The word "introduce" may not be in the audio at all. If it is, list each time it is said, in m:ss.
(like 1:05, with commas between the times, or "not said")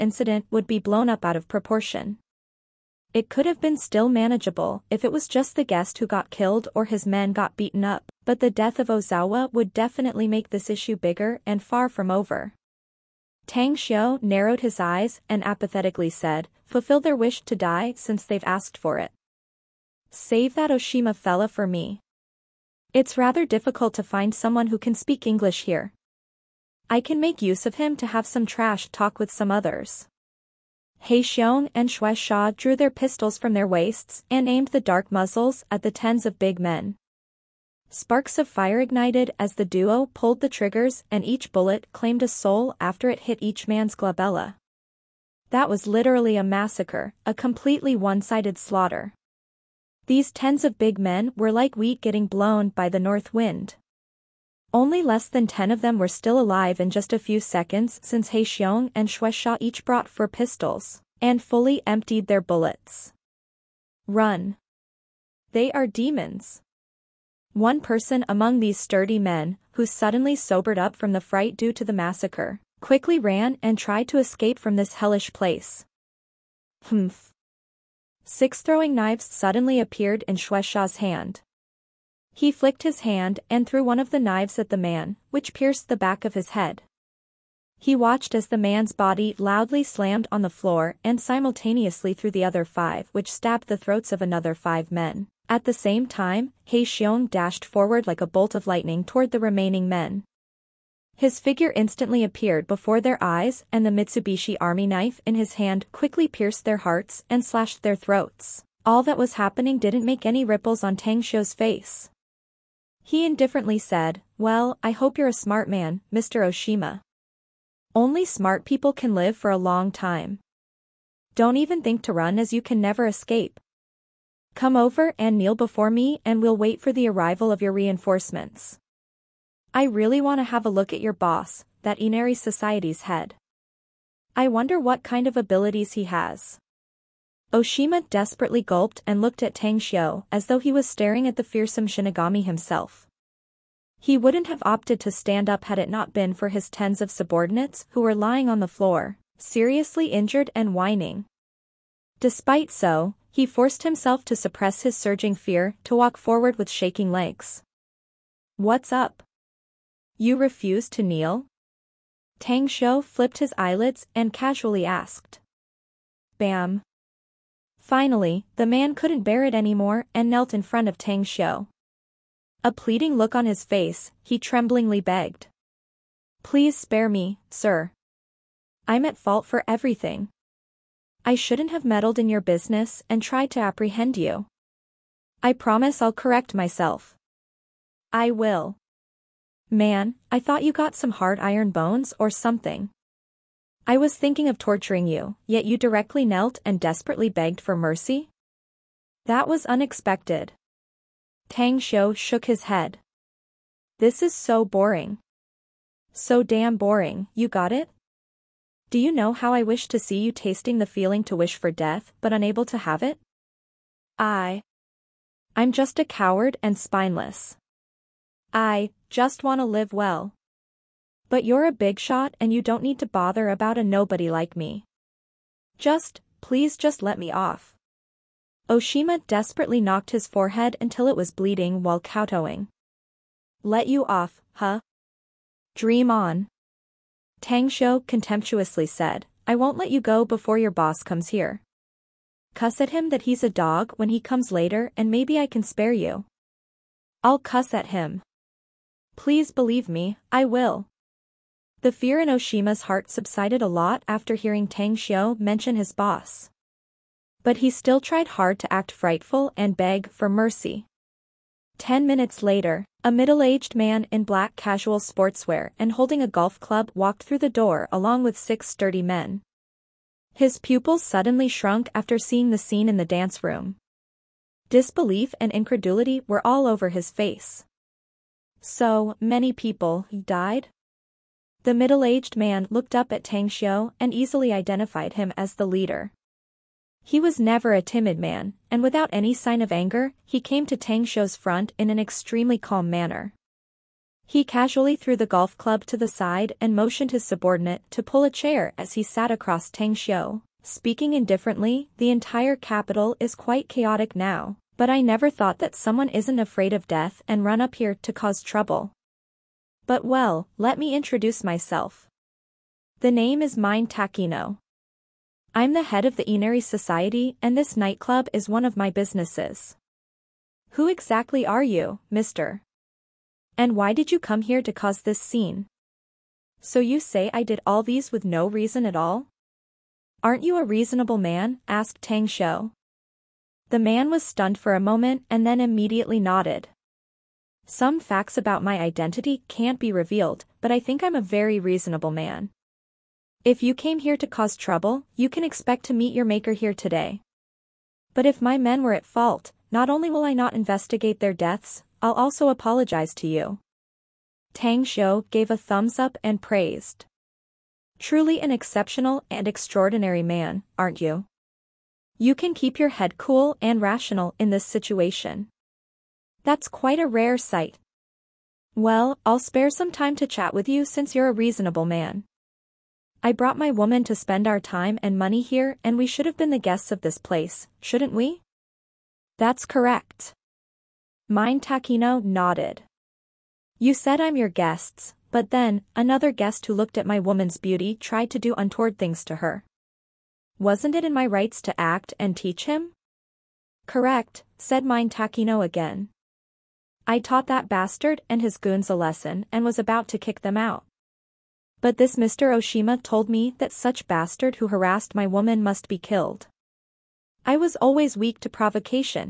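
5:10.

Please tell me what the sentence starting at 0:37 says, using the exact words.
Sparks of fire ignited as the duo pulled the triggers and each bullet claimed a soul after it hit each man's glabella.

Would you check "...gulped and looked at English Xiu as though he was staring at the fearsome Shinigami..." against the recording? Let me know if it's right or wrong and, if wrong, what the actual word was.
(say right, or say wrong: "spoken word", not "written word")
wrong: "Tang", not "English".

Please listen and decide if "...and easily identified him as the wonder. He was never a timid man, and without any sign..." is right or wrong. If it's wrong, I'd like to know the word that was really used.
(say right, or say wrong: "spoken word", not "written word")
wrong: "leader", not "wonder".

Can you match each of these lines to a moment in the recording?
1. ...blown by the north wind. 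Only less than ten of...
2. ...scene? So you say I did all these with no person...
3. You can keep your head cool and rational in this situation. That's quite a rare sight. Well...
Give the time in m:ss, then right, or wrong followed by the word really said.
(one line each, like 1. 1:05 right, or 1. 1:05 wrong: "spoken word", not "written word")
1. 0:52 right
2. 5:25 wrong: "reason", not "person"
3. 6:02 right.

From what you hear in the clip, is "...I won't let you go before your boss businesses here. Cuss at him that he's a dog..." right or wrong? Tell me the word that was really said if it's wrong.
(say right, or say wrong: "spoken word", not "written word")
wrong: "comes", not "businesses".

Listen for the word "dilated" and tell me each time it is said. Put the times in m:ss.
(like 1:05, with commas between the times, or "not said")
not said.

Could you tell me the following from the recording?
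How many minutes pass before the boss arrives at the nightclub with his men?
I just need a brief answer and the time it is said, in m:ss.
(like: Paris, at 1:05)
10, at 4:21.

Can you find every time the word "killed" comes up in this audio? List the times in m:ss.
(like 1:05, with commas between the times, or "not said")
0:06, 6:45.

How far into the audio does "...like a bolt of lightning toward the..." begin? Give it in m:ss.
1:38.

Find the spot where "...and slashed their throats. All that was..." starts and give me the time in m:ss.
1:47.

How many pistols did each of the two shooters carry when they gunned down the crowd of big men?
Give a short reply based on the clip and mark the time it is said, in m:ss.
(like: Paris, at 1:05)
4, at 1:00.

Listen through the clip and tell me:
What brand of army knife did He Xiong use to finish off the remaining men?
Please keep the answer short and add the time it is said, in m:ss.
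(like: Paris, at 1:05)
Mitsubishi, at 1:43.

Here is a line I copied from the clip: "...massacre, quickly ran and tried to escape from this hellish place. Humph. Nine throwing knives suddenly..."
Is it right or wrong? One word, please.
wrong.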